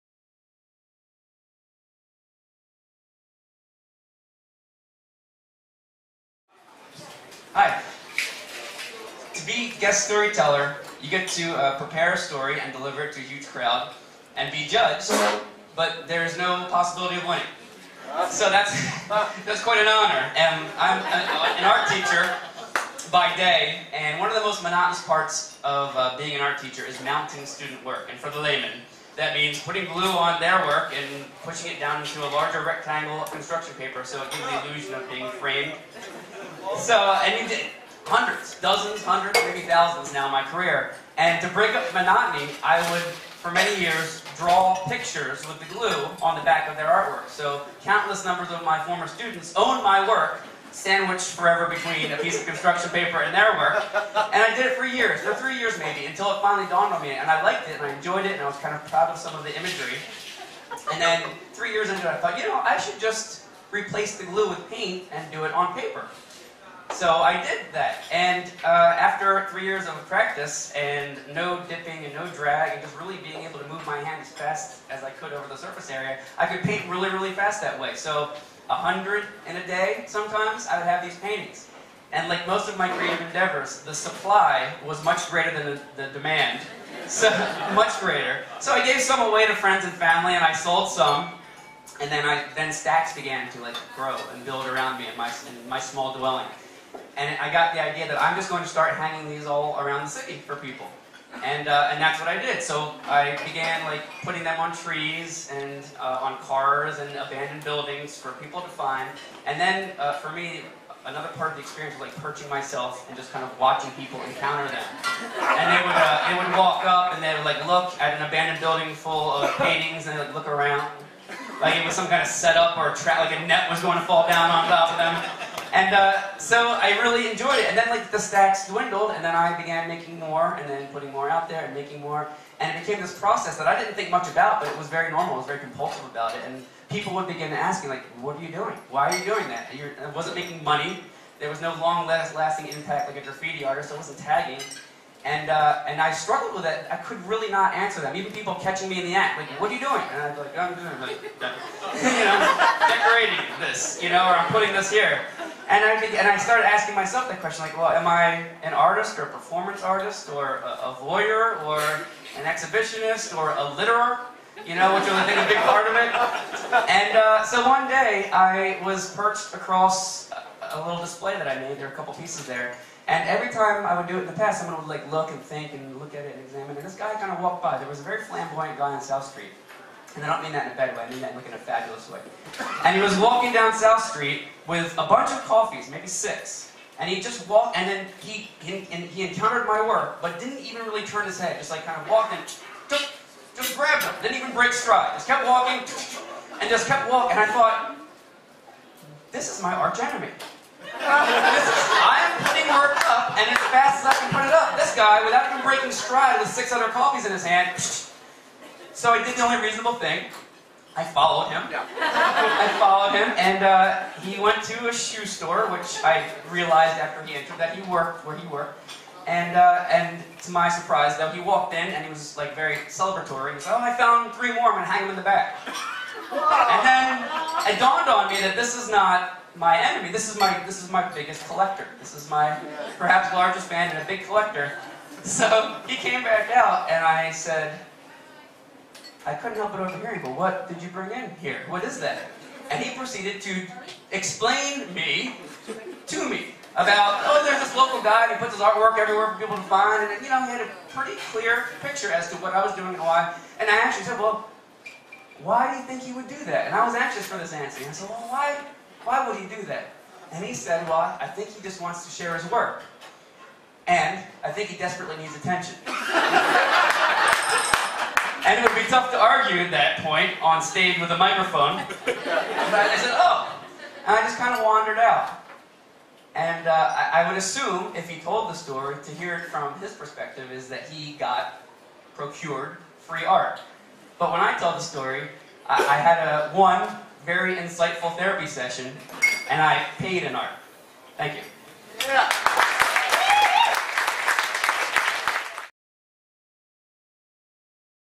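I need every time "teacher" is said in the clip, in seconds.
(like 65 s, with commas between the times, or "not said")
21 s, 26 s.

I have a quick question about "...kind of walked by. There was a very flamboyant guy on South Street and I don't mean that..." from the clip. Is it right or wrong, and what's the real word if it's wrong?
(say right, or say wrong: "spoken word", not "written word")
right.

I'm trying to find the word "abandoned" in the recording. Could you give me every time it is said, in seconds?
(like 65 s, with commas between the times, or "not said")
107 s, 118 s.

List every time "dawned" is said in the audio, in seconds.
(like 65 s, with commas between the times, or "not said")
56 s, 227 s.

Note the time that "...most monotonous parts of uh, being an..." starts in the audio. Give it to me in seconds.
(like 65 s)
24 s.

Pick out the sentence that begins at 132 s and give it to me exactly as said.
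And it became this process that I didn't think much about, but it was very normal.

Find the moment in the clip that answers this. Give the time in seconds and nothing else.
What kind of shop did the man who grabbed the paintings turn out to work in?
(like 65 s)
214 s.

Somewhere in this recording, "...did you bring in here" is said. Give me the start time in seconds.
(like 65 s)
240 s.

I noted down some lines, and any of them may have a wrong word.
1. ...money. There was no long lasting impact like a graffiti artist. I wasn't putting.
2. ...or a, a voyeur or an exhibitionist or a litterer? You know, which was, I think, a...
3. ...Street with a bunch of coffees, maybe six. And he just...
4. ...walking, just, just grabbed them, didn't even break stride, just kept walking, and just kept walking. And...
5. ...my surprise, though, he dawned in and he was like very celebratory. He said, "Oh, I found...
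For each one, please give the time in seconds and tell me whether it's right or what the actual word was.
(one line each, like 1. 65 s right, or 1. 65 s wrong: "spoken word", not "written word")
1. 140 s wrong: "tagging", not "putting"
2. 160 s right
3. 184 s right
4. 192 s right
5. 220 s wrong: "walked", not "dawned".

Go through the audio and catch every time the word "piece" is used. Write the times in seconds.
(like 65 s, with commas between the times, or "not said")
52 s, 172 s.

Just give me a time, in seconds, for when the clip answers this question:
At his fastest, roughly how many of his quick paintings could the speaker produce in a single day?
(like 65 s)
78 s.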